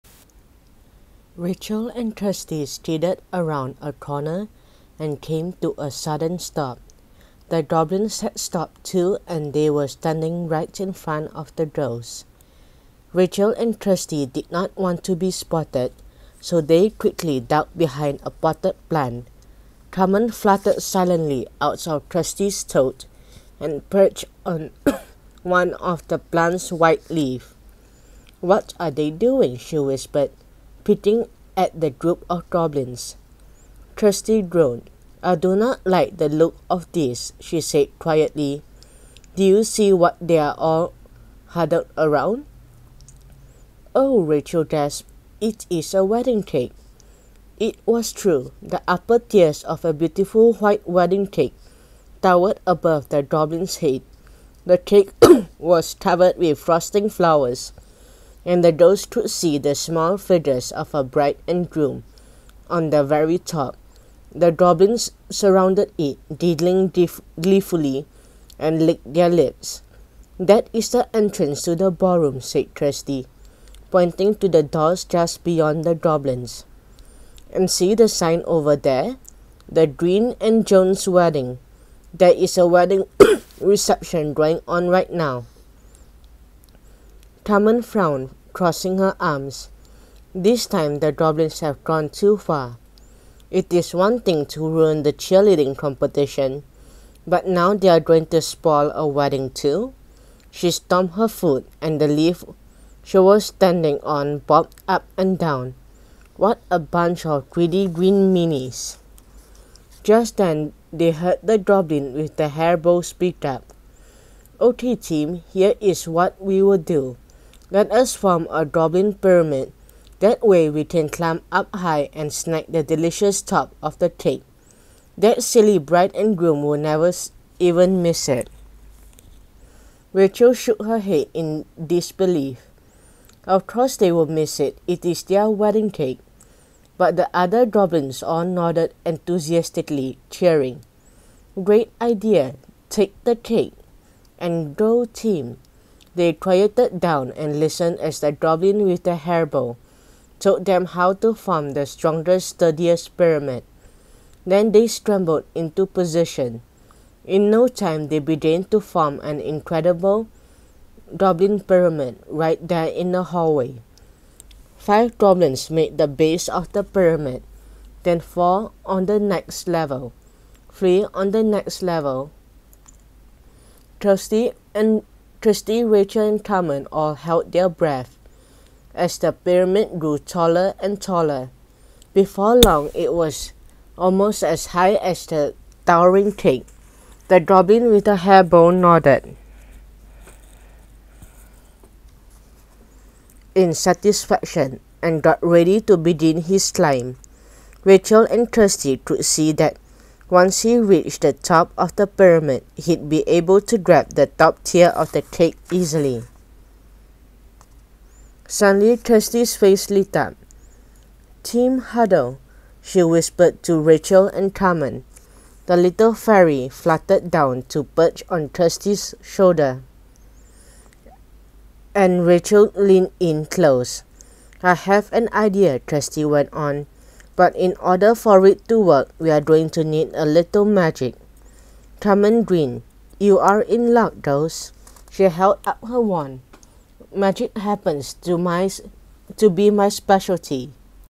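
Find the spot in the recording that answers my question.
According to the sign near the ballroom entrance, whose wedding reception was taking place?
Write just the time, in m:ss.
1:19.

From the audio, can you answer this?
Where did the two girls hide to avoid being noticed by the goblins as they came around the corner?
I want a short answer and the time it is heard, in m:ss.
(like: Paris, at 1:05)
Behind a potted plant, at 0:17.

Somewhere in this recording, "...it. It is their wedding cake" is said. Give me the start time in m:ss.
2:14.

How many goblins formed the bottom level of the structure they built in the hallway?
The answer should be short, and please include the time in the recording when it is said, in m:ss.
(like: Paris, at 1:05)
5, at 2:44.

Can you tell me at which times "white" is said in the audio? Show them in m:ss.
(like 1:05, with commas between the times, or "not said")
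0:26, 0:50.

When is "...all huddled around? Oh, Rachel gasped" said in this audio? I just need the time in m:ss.
0:40.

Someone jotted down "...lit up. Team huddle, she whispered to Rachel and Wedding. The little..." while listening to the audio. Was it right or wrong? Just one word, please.
wrong.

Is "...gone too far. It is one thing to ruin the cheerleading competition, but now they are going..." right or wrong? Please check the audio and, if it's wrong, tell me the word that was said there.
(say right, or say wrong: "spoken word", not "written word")
right.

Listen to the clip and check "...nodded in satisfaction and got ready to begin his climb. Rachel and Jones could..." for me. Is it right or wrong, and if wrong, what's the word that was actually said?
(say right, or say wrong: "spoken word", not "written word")
wrong: "Kirsty", not "Jones".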